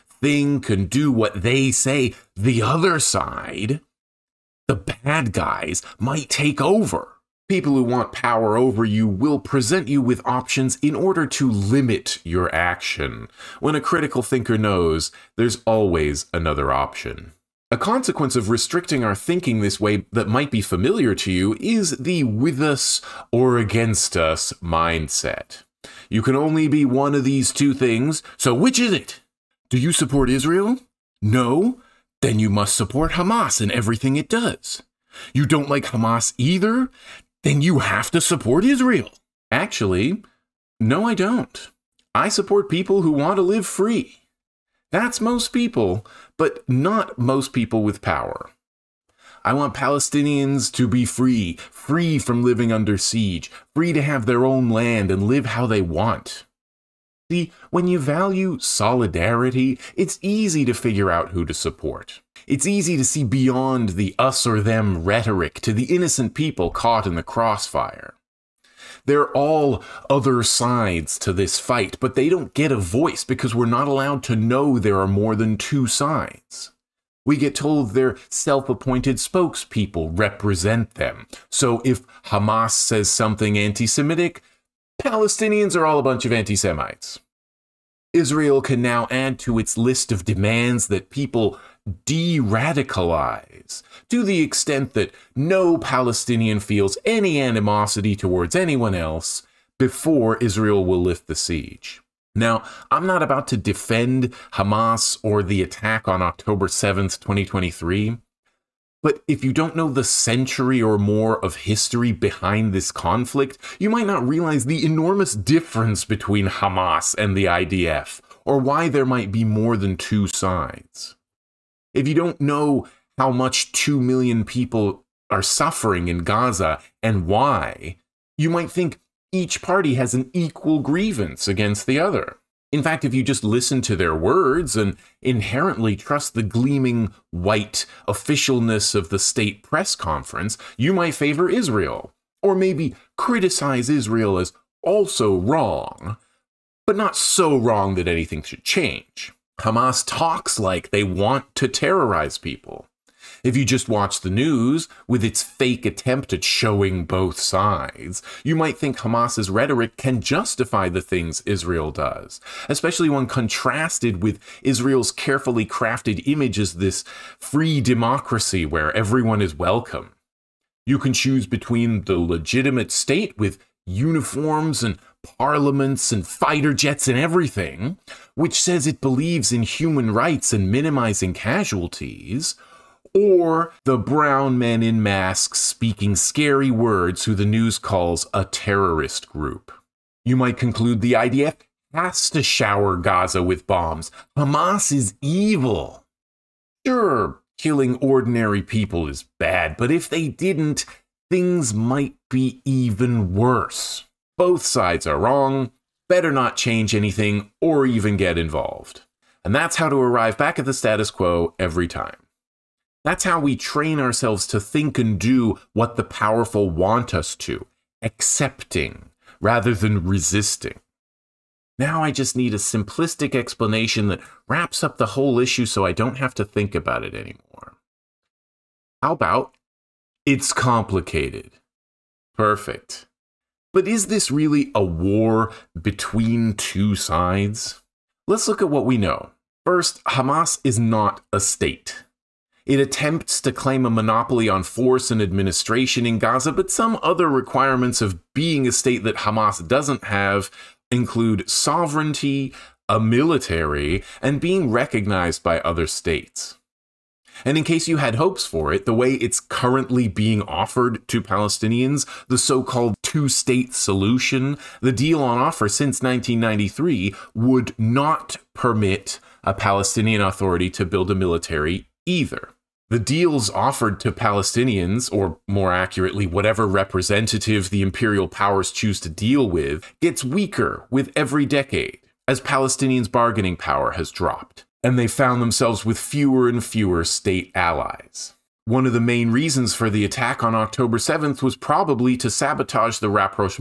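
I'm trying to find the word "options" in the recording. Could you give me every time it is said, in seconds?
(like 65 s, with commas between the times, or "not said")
10 s, 16 s.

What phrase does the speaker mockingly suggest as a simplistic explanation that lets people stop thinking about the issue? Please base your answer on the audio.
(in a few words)
It's complicated.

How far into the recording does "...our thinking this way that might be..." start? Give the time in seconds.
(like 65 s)
19 s.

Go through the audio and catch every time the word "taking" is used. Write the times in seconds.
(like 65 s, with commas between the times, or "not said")
not said.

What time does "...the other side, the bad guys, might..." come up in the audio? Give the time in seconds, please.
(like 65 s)
2 s.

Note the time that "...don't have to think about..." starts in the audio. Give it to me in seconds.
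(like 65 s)
225 s.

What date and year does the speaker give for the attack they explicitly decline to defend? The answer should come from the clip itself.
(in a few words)
October 7th, 2023.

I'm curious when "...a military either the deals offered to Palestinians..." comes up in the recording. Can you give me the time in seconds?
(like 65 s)
271 s.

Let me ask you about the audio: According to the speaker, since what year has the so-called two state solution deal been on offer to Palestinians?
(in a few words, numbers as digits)
1993.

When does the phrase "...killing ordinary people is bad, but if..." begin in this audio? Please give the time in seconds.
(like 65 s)
197 s.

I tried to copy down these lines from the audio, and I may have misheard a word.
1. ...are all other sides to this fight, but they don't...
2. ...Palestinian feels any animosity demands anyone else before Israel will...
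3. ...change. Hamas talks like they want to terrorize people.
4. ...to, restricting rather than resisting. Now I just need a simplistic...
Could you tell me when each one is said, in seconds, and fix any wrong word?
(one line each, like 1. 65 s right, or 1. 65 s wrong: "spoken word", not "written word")
1. 69 s right
2. 95 s wrong: "towards", not "demands"
3. 148 s right
4. 217 s wrong: "accepting", not "restricting".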